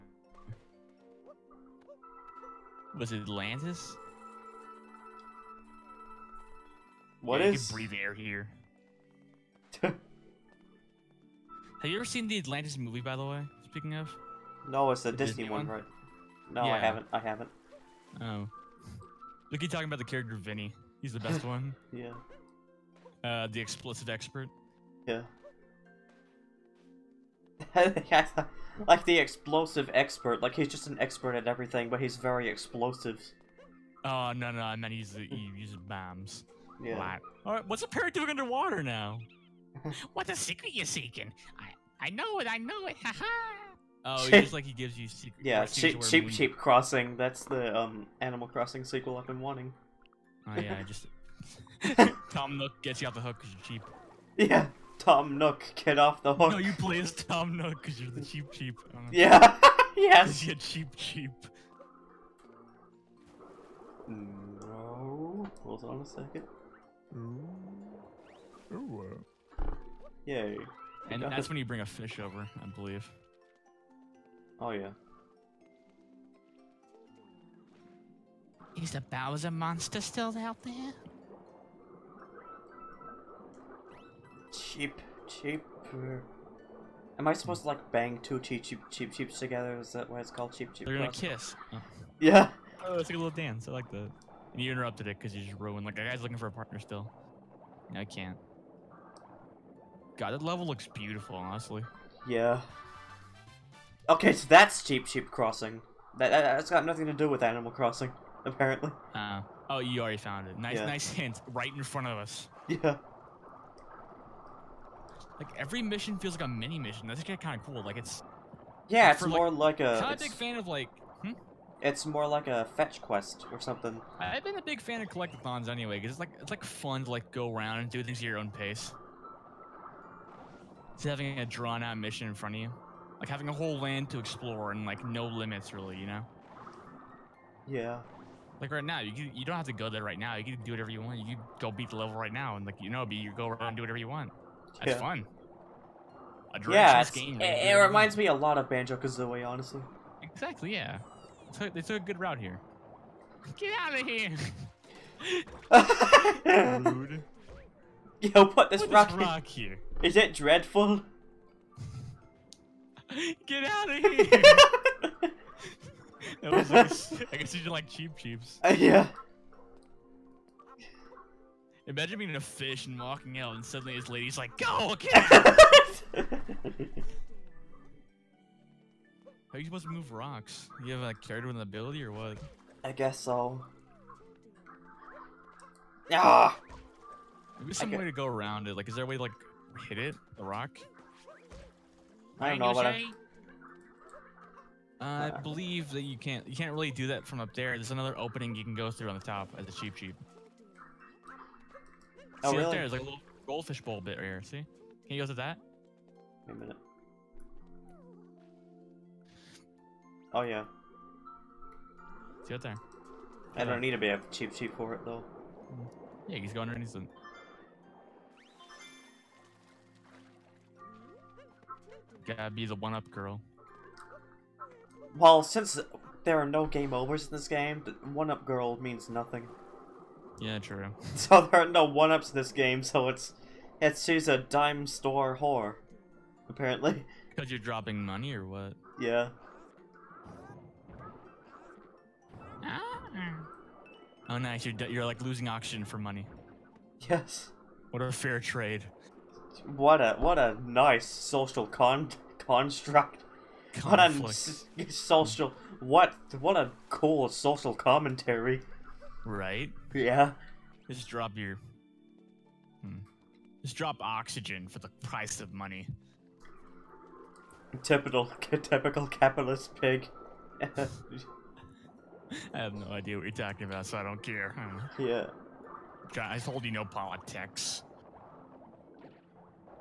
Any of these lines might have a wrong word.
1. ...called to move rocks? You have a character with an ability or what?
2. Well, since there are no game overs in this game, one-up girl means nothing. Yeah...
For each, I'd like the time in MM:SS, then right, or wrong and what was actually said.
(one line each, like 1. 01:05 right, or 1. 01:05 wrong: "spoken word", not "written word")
1. 02:59 wrong: "supposed", not "called"
2. 03:45 right.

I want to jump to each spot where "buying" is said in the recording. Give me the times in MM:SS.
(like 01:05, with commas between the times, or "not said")
not said.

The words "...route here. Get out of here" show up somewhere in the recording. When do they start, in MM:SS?
02:32.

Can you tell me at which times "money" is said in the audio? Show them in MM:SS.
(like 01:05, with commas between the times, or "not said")
03:58, 04:05, 04:25.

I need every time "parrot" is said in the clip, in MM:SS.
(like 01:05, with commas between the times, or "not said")
00:37.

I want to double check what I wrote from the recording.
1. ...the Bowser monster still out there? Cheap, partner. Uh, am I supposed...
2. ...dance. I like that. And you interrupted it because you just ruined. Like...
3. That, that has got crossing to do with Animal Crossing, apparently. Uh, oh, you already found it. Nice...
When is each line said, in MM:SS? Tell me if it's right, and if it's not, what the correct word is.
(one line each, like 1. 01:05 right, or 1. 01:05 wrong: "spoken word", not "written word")
1. 01:18 wrong: "cheaper", not "partner"
2. 01:33 right
3. 01:46 wrong: "nothing", not "crossing".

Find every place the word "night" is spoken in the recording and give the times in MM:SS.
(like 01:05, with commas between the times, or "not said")
not said.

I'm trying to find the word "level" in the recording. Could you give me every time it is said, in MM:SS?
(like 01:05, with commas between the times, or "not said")
01:40, 02:21.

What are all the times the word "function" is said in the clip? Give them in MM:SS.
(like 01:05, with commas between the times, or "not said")
not said.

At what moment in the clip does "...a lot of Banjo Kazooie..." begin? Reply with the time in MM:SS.
02:28.